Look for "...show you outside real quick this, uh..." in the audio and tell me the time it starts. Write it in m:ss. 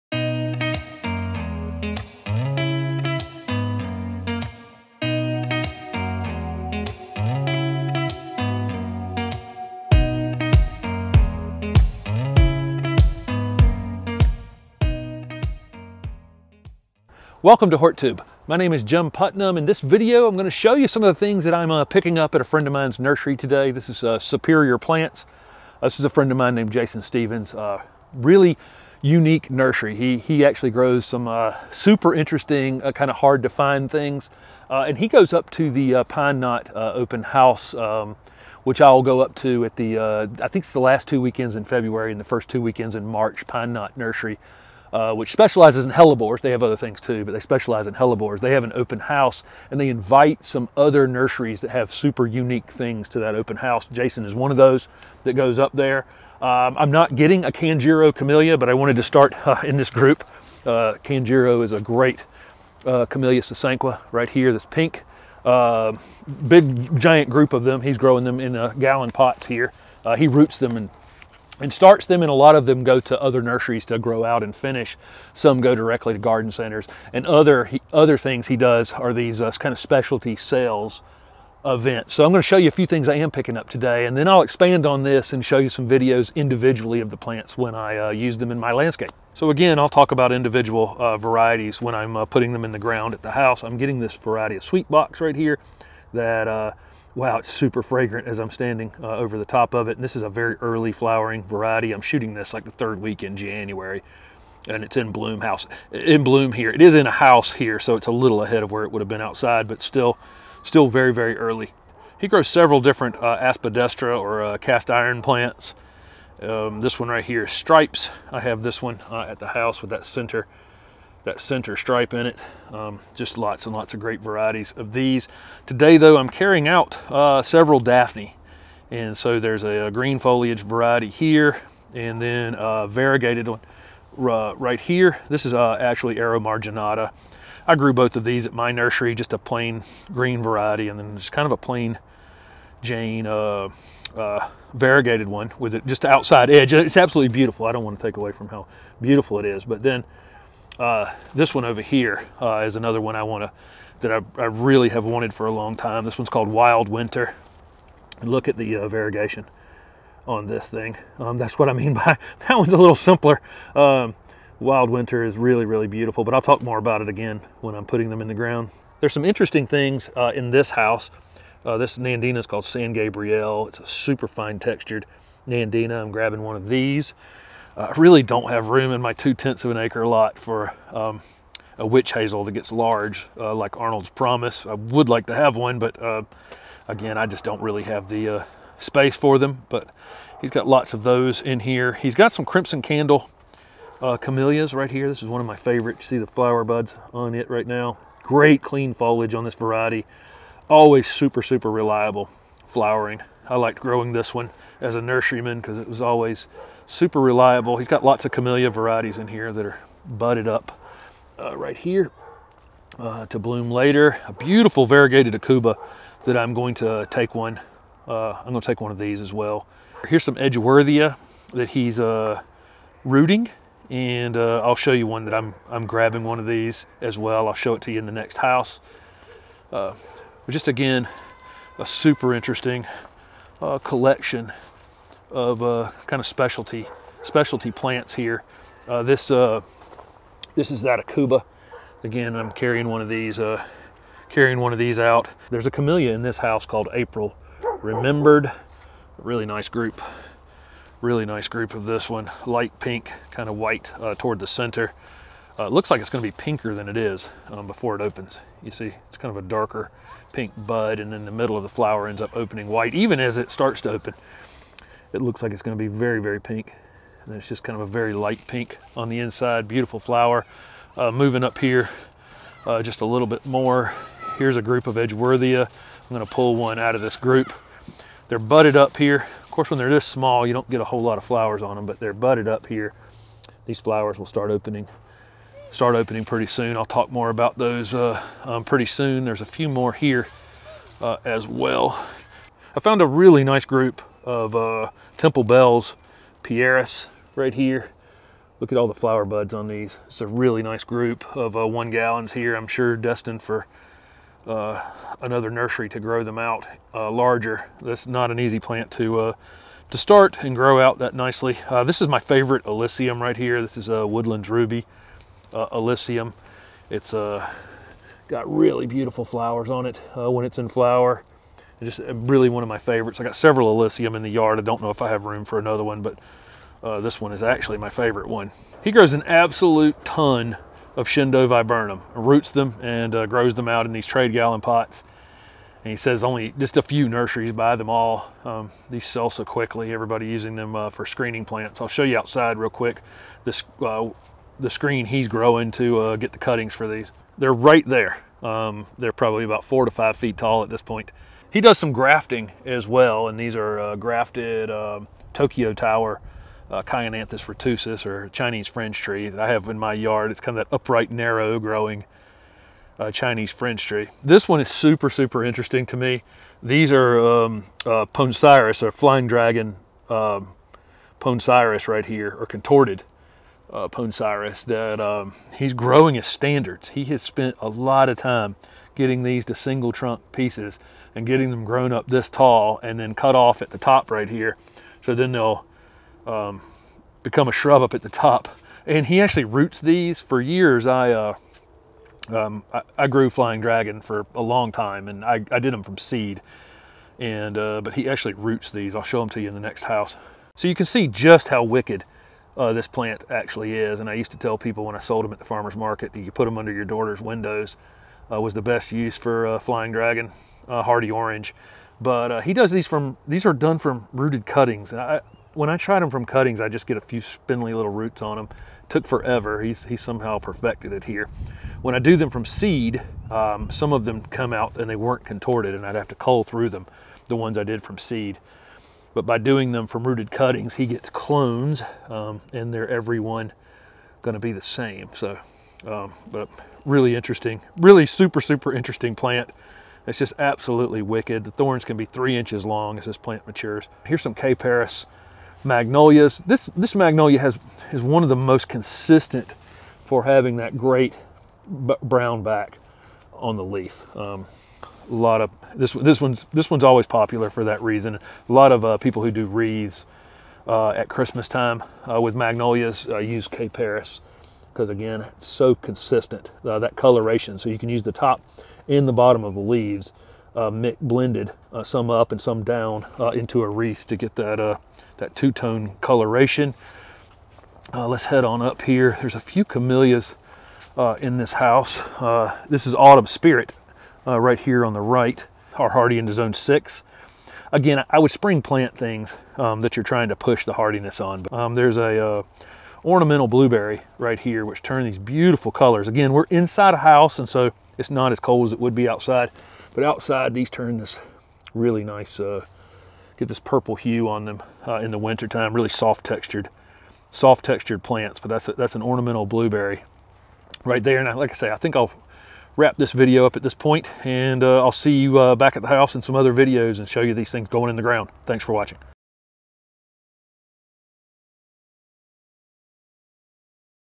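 5:41.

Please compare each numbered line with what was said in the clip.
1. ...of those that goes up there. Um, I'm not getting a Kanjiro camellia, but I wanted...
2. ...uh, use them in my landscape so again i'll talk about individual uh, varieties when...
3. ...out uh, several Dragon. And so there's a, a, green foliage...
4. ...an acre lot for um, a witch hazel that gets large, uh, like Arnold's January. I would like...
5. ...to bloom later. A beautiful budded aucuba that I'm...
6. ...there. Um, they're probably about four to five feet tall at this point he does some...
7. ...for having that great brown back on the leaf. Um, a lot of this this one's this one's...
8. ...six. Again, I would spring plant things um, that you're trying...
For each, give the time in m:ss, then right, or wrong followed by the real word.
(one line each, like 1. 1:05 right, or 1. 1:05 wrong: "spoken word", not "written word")
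1. 0:54 right
2. 1:27 right
3. 2:06 wrong: "Daphne", not "Dragon"
4. 2:59 wrong: "Promise", not "January"
5. 3:33 wrong: "variegated", not "budded"
6. 5:47 right
7. 7:30 right
8. 8:06 right.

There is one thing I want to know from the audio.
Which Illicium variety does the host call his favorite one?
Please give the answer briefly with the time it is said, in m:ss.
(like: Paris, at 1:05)
Woodlands Ruby, at 5:14.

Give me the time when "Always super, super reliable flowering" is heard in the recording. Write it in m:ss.
3:20.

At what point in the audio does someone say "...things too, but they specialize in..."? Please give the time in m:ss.
0:46.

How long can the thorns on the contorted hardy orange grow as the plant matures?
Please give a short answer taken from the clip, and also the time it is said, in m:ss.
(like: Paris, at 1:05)
3 inches, at 7:22.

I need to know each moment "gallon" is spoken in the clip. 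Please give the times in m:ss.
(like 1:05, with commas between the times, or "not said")
1:08, 5:01, 5:34.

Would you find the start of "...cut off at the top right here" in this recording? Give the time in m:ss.
6:23.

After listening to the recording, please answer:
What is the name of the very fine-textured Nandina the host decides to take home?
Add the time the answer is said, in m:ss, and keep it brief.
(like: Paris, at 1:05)
San Gabriel, at 2:52.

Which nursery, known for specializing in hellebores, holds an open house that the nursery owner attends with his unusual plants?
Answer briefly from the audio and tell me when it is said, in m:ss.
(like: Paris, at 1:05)
Pine Knot Nursery, at 0:43.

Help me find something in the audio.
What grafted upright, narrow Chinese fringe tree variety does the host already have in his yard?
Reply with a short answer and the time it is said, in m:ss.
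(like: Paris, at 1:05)
Tokyo Tower, at 5:55.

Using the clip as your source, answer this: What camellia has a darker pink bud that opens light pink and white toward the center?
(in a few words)
April Remembered.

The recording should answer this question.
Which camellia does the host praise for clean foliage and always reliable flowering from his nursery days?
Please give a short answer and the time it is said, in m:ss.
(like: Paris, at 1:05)
Crimson Candle, at 3:12.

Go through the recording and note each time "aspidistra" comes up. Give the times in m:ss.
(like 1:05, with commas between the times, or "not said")
1:53.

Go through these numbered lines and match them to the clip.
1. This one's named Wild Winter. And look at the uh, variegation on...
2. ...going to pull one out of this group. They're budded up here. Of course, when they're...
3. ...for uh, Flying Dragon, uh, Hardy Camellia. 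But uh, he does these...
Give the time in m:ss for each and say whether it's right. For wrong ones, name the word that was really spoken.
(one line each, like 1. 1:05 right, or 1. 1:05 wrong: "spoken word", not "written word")
1. 2:36 wrong: "called", not "named"
2. 4:36 right
3. 6:49 wrong: "Orange", not "Camellia".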